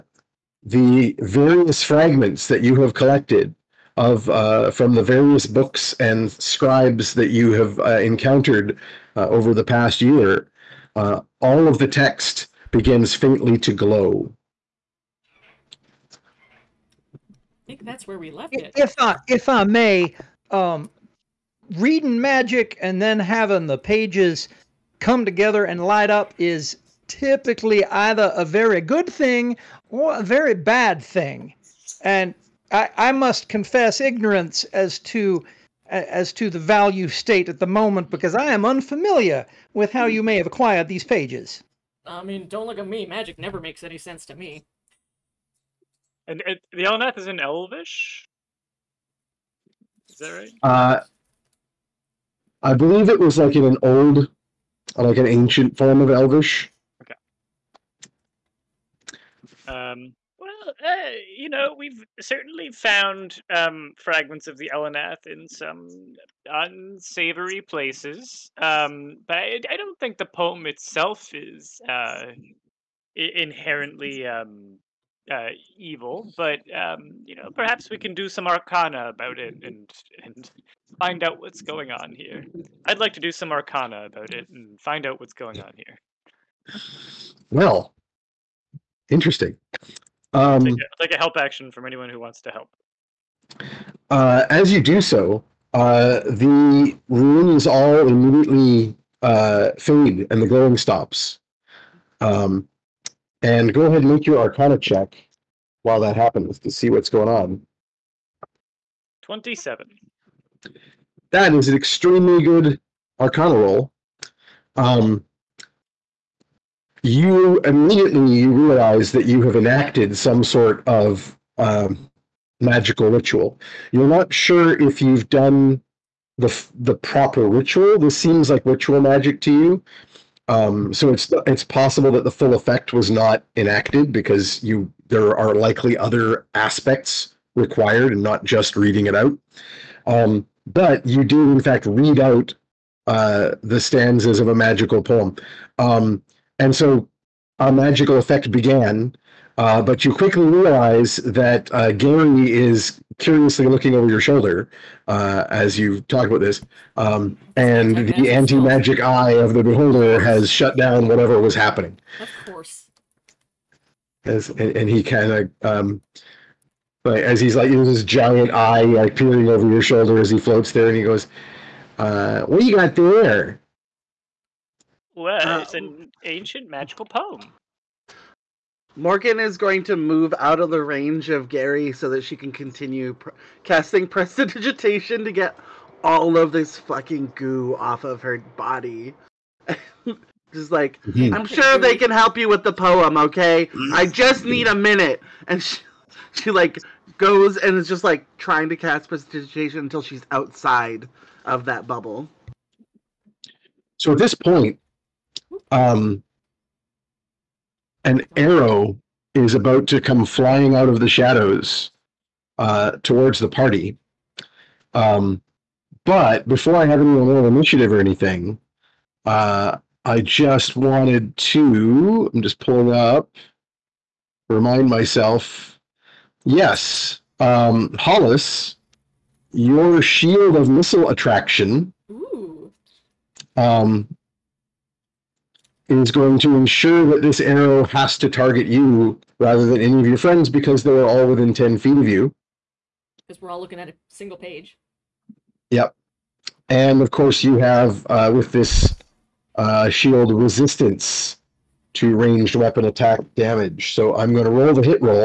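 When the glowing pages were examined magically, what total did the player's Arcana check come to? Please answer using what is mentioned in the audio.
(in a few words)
27.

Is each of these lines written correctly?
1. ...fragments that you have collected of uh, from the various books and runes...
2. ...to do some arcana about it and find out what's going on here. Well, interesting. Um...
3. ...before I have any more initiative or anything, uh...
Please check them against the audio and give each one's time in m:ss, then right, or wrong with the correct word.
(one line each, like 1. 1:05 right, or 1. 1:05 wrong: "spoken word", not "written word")
1. 0:01 wrong: "scribes", not "runes"
2. 1:23 right
3. 3:36 right.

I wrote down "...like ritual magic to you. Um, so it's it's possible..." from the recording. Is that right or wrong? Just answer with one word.
right.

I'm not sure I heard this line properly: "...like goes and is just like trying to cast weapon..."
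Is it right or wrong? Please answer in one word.
wrong.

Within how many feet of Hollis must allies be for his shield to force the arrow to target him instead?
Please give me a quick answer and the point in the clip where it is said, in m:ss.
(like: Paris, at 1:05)
10 feet, at 4:01.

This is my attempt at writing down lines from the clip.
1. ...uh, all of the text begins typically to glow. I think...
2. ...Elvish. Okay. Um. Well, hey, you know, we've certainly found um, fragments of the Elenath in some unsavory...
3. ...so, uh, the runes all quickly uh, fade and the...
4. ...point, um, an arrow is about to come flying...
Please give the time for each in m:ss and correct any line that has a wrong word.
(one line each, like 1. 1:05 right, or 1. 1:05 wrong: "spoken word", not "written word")
1. 0:10 wrong: "faintly", not "typically"
2. 0:56 right
3. 1:35 wrong: "immediately", not "quickly"
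4. 3:24 right.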